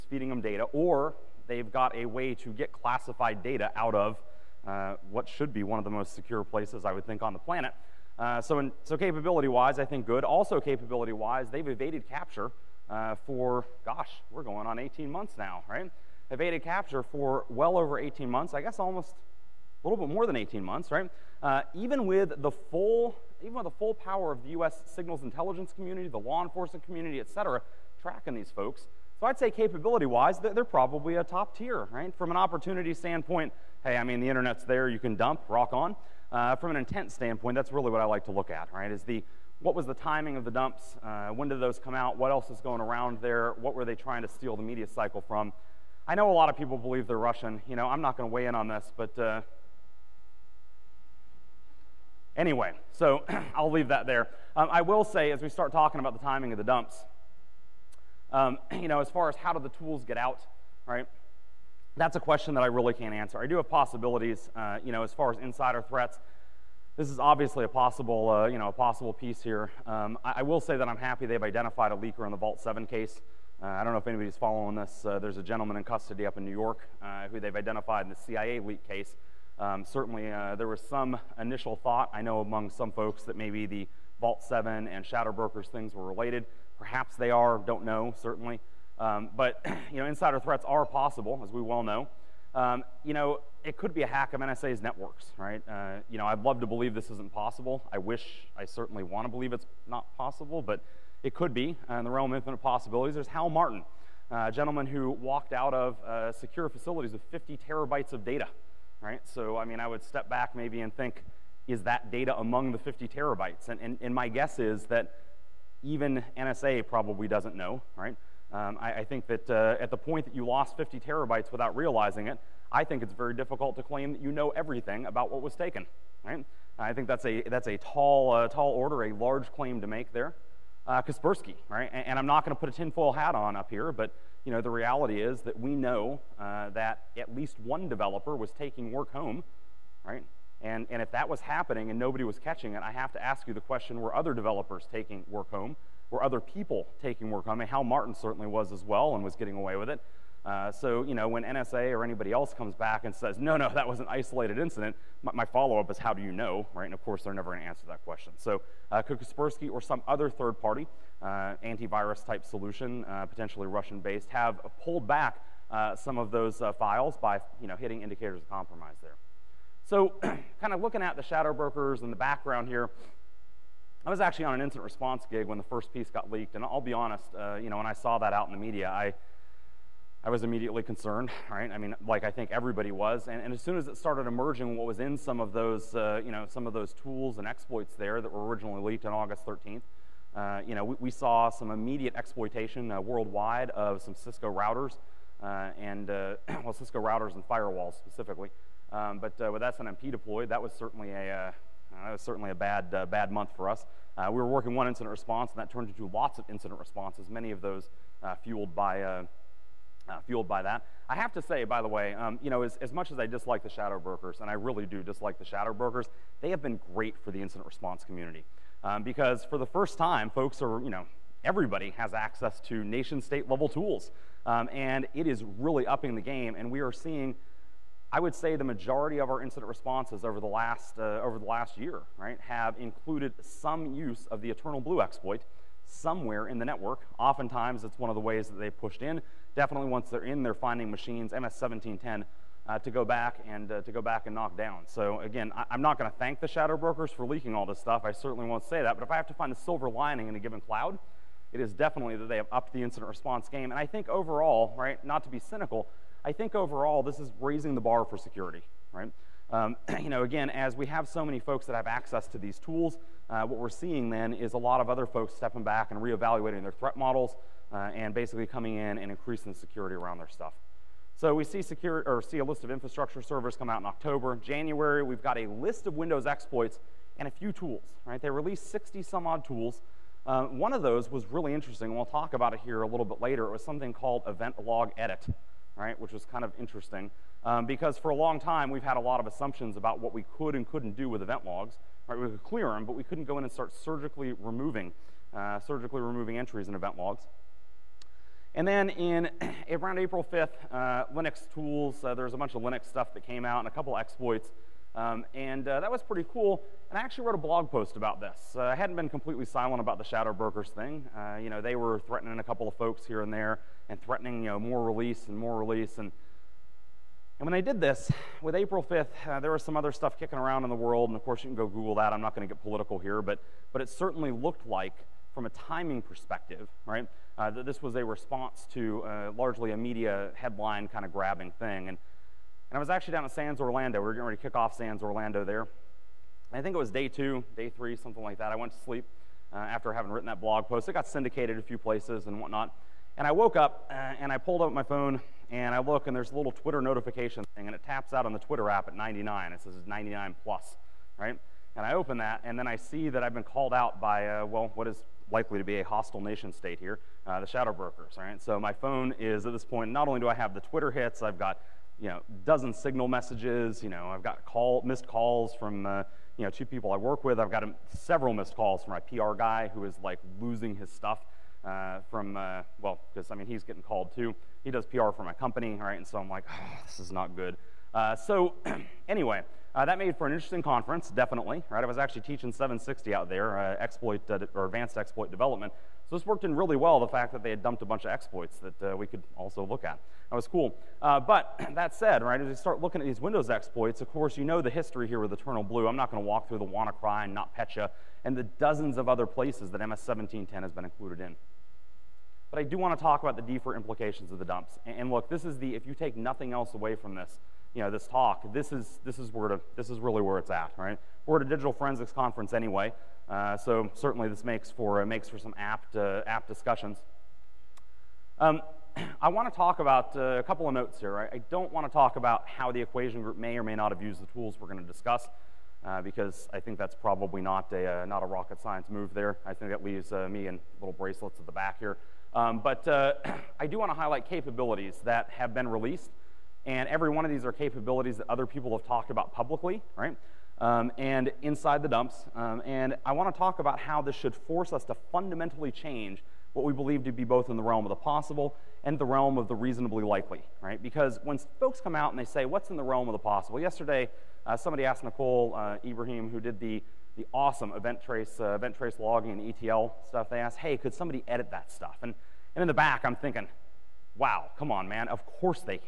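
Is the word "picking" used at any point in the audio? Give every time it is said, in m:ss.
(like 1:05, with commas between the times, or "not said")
not said.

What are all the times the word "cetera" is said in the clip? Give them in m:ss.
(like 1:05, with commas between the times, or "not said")
0:27.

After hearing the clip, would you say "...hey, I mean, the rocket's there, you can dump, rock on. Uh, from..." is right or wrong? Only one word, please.
wrong.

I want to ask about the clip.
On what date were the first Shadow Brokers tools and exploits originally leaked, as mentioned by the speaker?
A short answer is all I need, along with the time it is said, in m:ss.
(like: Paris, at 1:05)
August 13th, at 3:09.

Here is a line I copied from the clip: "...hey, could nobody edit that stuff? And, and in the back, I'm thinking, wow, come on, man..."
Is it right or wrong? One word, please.
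wrong.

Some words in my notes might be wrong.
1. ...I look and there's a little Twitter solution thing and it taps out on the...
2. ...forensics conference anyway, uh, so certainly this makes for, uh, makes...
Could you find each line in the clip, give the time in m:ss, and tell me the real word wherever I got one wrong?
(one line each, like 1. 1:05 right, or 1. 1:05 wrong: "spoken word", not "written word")
1. 5:45 wrong: "notification", not "solution"
2. 6:51 right.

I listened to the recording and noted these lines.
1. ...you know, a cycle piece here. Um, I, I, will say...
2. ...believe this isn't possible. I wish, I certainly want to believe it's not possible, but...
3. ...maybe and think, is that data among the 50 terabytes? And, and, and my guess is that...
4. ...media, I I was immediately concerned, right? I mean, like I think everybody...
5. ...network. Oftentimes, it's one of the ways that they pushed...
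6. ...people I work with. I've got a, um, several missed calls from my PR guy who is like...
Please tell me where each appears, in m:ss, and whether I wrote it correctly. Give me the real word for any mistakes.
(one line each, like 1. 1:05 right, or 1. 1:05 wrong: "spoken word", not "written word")
1. 1:08 wrong: "possible", not "cycle"
2. 1:36 right
3. 1:50 right
4. 2:58 right
5. 3:56 right
6. 6:06 right.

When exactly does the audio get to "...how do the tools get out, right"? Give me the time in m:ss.
0:59.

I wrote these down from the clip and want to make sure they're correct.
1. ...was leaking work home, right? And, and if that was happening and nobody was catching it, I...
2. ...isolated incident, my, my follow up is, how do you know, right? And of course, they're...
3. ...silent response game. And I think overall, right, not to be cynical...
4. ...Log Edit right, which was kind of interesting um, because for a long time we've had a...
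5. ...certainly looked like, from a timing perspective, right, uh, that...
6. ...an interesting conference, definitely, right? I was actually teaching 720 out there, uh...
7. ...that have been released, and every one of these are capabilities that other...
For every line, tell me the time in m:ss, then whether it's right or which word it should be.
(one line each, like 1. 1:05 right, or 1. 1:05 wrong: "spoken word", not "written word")
1. 2:18 wrong: "taking", not "leaking"
2. 2:34 right
3. 4:12 wrong: "incident", not "silent"
4. 4:44 right
5. 5:23 right
6. 6:20 wrong: "760", not "720"
7. 7:15 right.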